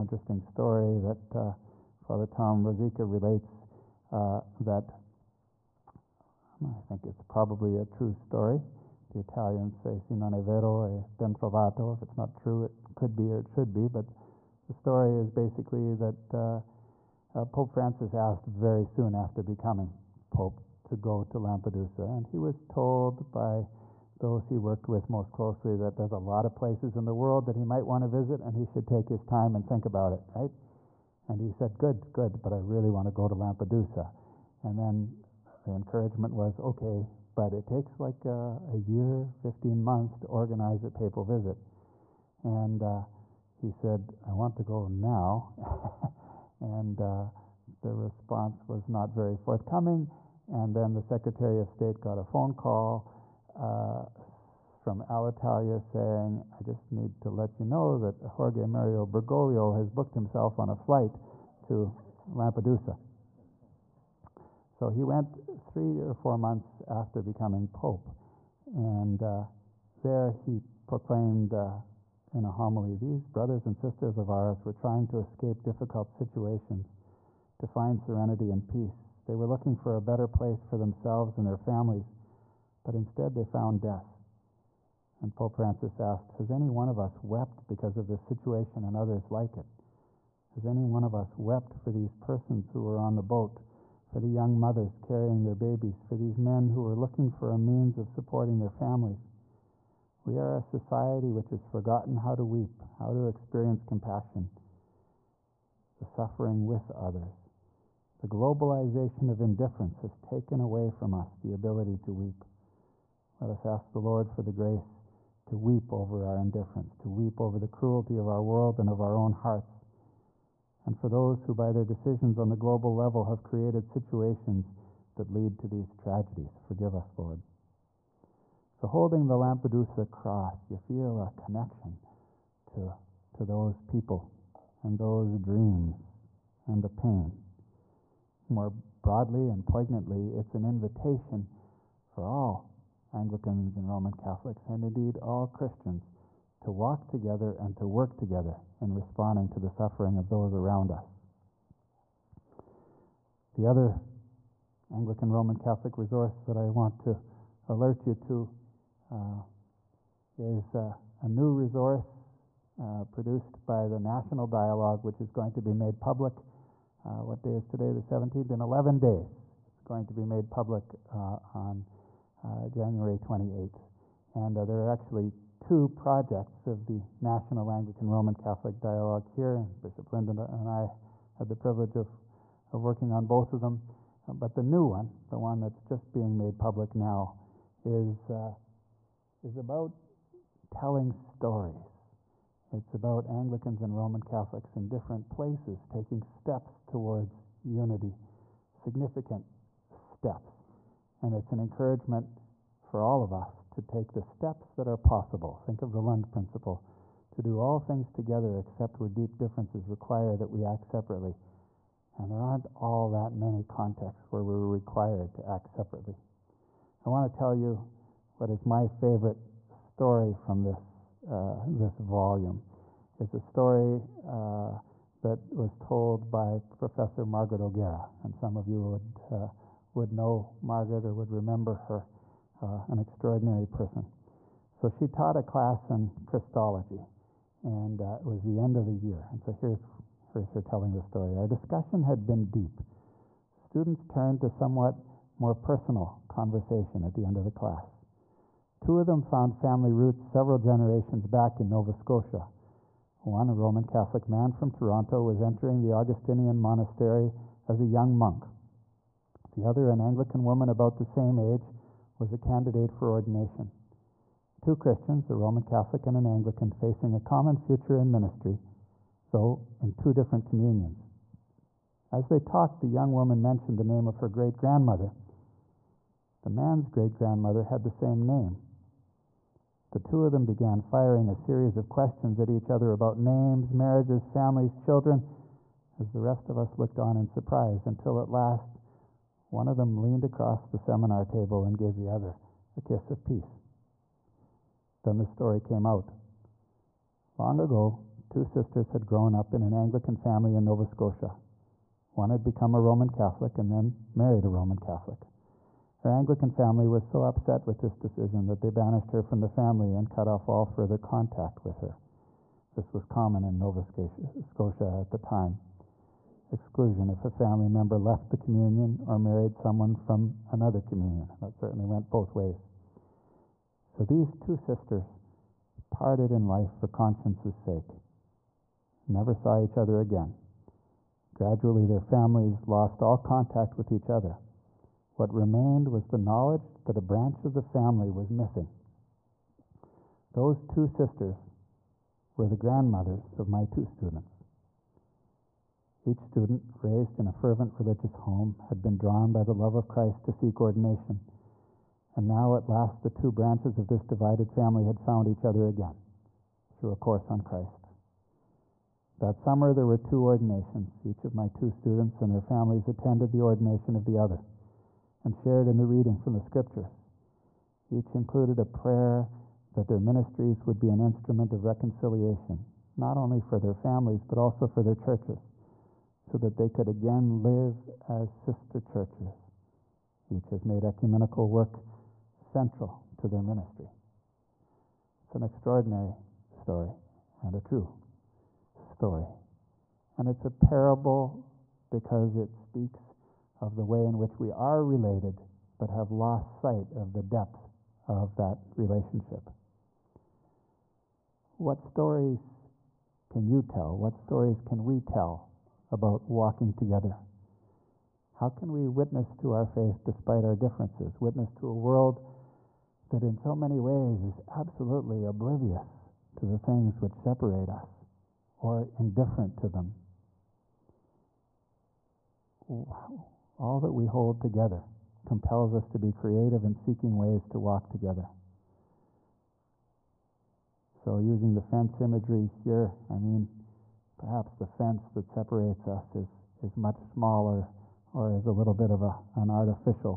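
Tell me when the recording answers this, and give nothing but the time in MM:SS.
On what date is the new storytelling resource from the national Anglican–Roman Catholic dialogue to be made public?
02:52.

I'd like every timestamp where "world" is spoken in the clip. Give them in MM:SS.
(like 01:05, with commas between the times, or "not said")
00:27, 01:58, 06:51.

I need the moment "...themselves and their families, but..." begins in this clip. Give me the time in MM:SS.
01:20.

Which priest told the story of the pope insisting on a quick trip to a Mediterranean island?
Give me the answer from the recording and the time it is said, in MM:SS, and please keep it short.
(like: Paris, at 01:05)
Father Tom Rosica, at 00:01.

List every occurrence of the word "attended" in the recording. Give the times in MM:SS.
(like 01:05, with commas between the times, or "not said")
06:02.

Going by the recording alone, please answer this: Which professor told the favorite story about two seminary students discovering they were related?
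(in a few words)
Margaret O'Gara.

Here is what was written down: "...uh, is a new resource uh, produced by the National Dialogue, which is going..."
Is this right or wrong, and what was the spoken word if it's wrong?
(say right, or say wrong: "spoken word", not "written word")
right.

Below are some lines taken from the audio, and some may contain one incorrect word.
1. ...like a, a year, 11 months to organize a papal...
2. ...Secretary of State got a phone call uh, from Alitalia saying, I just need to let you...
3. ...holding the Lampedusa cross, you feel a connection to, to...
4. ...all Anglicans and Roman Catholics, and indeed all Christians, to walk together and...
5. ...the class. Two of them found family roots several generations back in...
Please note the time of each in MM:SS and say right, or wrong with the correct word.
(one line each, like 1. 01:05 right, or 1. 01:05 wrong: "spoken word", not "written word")
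1. 00:37 wrong: "15", not "11"
2. 00:51 right
3. 02:08 right
4. 02:22 right
5. 04:07 right.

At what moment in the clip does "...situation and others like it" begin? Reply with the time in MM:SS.
01:28.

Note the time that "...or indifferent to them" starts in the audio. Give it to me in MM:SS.
06:58.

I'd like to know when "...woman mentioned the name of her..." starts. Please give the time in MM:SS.
04:33.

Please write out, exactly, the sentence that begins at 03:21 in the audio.
And it's an encouragement for all of us to take the steps that are possible.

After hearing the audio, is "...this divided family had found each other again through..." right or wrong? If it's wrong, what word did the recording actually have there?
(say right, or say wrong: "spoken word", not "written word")
right.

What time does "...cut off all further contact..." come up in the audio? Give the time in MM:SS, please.
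05:10.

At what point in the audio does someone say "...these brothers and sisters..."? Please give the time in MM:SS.
01:12.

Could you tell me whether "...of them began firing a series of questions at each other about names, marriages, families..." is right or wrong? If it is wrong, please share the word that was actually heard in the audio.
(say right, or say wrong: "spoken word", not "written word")
right.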